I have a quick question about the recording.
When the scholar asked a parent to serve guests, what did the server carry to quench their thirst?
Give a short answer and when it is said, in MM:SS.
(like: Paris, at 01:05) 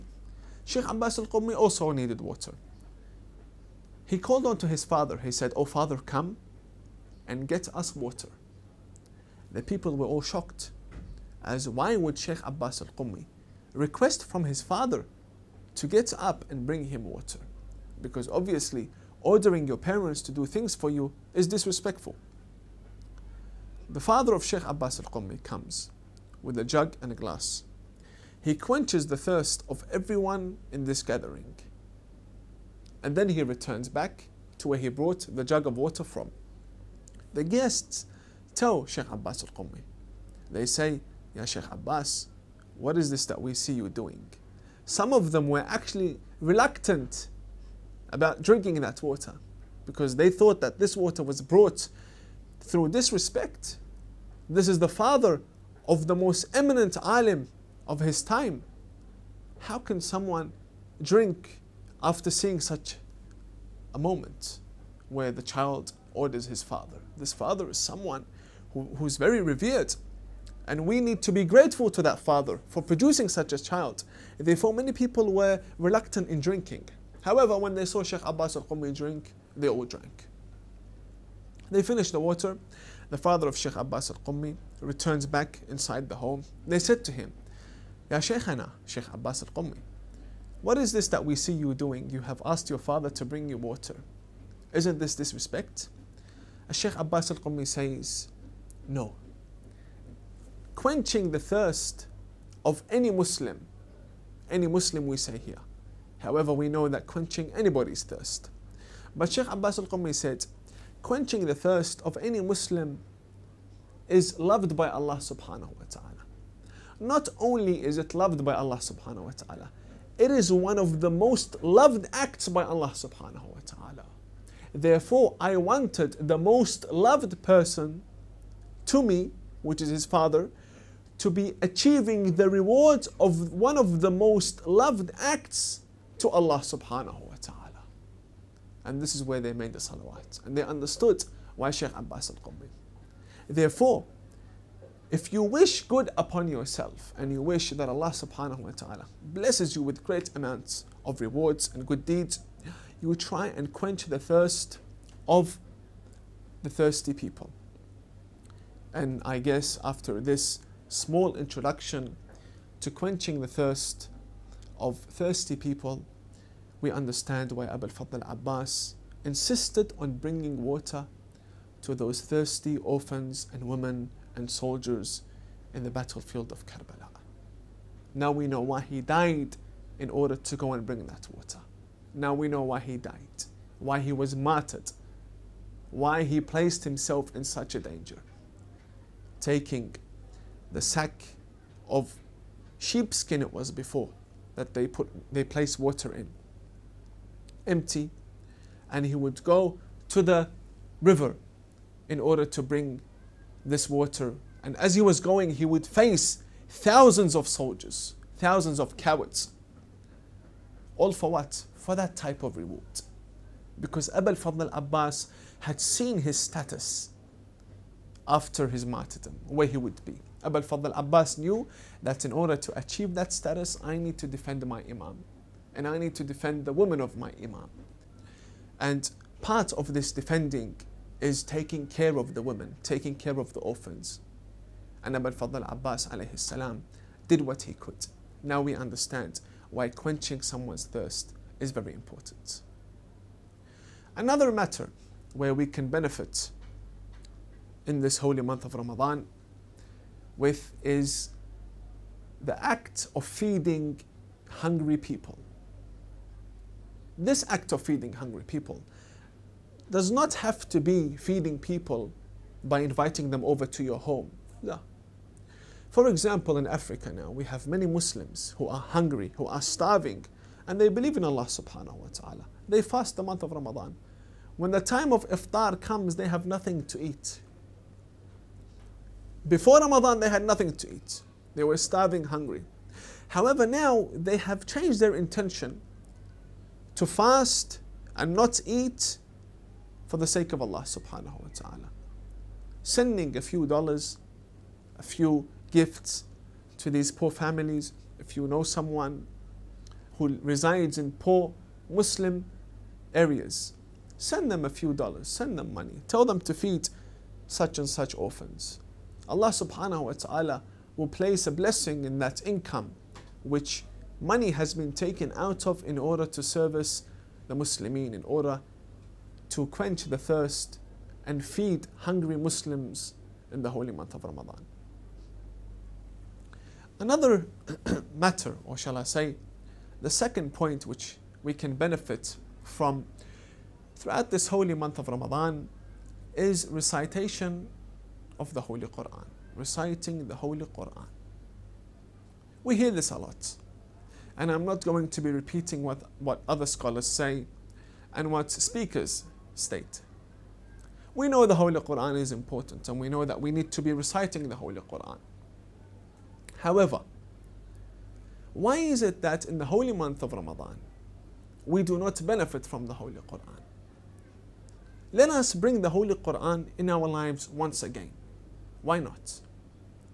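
A jug and a glass, at 00:26.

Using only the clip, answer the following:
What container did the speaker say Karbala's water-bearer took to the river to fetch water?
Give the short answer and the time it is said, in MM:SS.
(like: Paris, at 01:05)
Sack of sheepskin, at 03:10.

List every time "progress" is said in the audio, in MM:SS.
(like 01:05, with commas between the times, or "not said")
not said.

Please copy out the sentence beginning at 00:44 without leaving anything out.
Some of them were actually reluctant about drinking that water because they thought that this water was brought through disrespect.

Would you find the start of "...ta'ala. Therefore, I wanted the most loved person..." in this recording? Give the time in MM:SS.
02:03.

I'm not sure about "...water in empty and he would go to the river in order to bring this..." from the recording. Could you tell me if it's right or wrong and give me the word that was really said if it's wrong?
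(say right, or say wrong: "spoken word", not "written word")
right.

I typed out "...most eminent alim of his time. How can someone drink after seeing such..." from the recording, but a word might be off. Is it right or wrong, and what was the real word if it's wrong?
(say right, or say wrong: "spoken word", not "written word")
right.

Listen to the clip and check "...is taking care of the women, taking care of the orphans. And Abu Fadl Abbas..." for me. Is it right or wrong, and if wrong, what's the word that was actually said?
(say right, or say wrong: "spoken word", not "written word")
right.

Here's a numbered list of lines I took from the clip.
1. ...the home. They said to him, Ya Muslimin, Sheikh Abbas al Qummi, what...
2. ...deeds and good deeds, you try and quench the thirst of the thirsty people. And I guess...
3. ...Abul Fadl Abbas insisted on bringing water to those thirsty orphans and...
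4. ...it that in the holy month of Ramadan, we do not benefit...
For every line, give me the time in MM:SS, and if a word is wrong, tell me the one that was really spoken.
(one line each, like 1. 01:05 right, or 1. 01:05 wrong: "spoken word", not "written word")
1. 01:26 wrong: "Sheikhana", not "Muslimin"
2. 02:31 wrong: "rewards", not "deeds"
3. 02:47 right
4. 05:59 right.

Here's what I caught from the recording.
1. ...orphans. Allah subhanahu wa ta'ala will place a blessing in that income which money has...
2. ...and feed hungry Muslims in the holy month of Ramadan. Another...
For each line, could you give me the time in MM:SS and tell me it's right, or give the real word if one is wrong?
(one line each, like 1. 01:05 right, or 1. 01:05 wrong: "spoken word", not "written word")
1. 05:08 right
2. 05:21 right.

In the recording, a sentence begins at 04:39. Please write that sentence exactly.
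Before Ramadan, they had nothing to eat.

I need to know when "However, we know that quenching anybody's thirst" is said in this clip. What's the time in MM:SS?
01:46.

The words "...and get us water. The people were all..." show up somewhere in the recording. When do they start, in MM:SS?
00:07.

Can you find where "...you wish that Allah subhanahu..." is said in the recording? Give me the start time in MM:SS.
02:27.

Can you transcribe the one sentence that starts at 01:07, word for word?
This father is someone who's very revered.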